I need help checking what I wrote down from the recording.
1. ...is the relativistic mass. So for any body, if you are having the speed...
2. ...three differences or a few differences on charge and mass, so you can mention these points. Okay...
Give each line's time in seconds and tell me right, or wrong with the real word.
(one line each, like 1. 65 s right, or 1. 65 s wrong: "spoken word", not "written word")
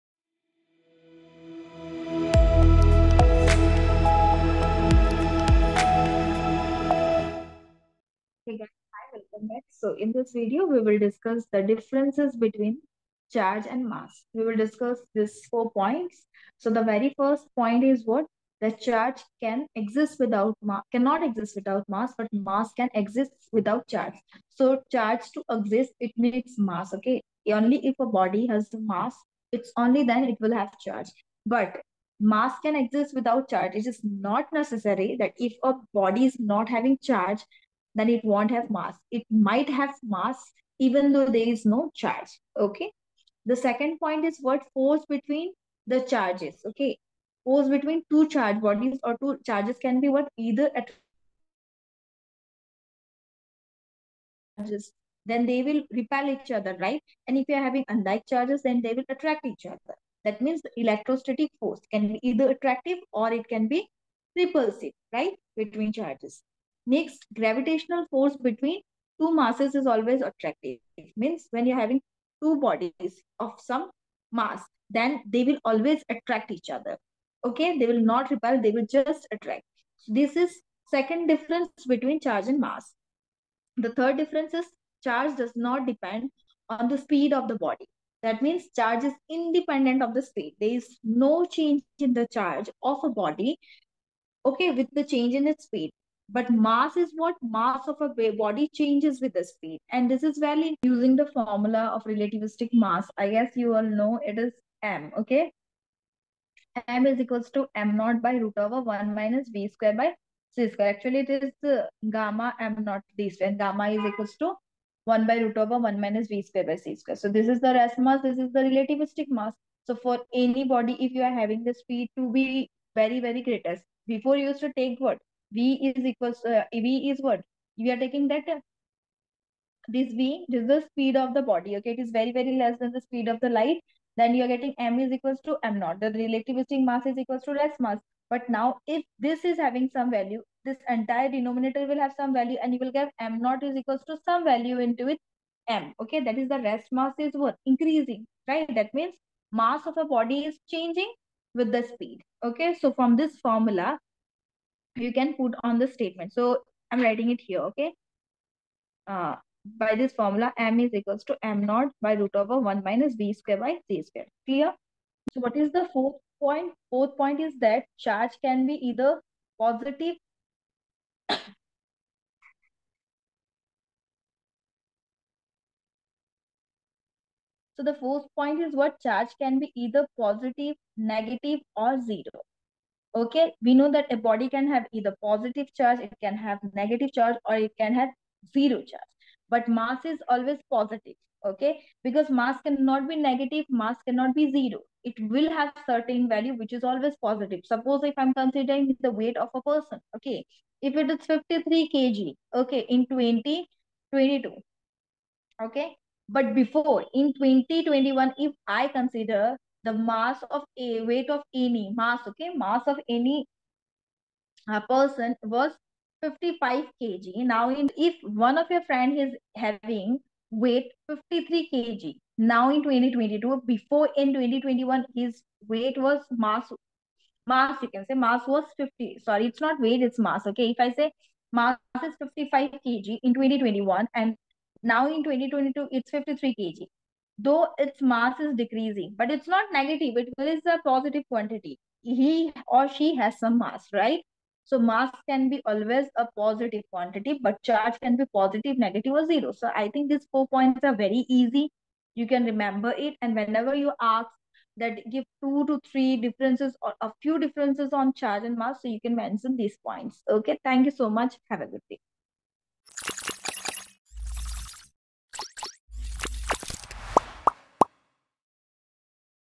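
1. 118 s right
2. 255 s right.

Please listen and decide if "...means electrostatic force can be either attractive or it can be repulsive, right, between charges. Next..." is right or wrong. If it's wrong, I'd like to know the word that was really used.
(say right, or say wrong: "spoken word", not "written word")
right.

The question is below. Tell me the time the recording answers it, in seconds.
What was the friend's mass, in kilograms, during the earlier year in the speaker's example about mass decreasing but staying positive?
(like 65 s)
232 s.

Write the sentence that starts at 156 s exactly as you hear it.
So I'm writing it here, okay?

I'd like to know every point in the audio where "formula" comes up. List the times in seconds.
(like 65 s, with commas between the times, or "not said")
101 s, 153 s, 160 s.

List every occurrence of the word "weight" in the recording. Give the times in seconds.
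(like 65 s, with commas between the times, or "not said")
199 s, 211 s, 220 s, 225 s, 229 s.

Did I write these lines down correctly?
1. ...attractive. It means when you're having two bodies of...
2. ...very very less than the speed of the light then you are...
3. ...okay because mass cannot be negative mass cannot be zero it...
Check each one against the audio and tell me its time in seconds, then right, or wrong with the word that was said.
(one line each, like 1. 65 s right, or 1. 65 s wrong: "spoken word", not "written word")
1. 70 s right
2. 132 s right
3. 191 s right.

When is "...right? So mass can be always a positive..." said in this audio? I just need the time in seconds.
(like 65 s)
243 s.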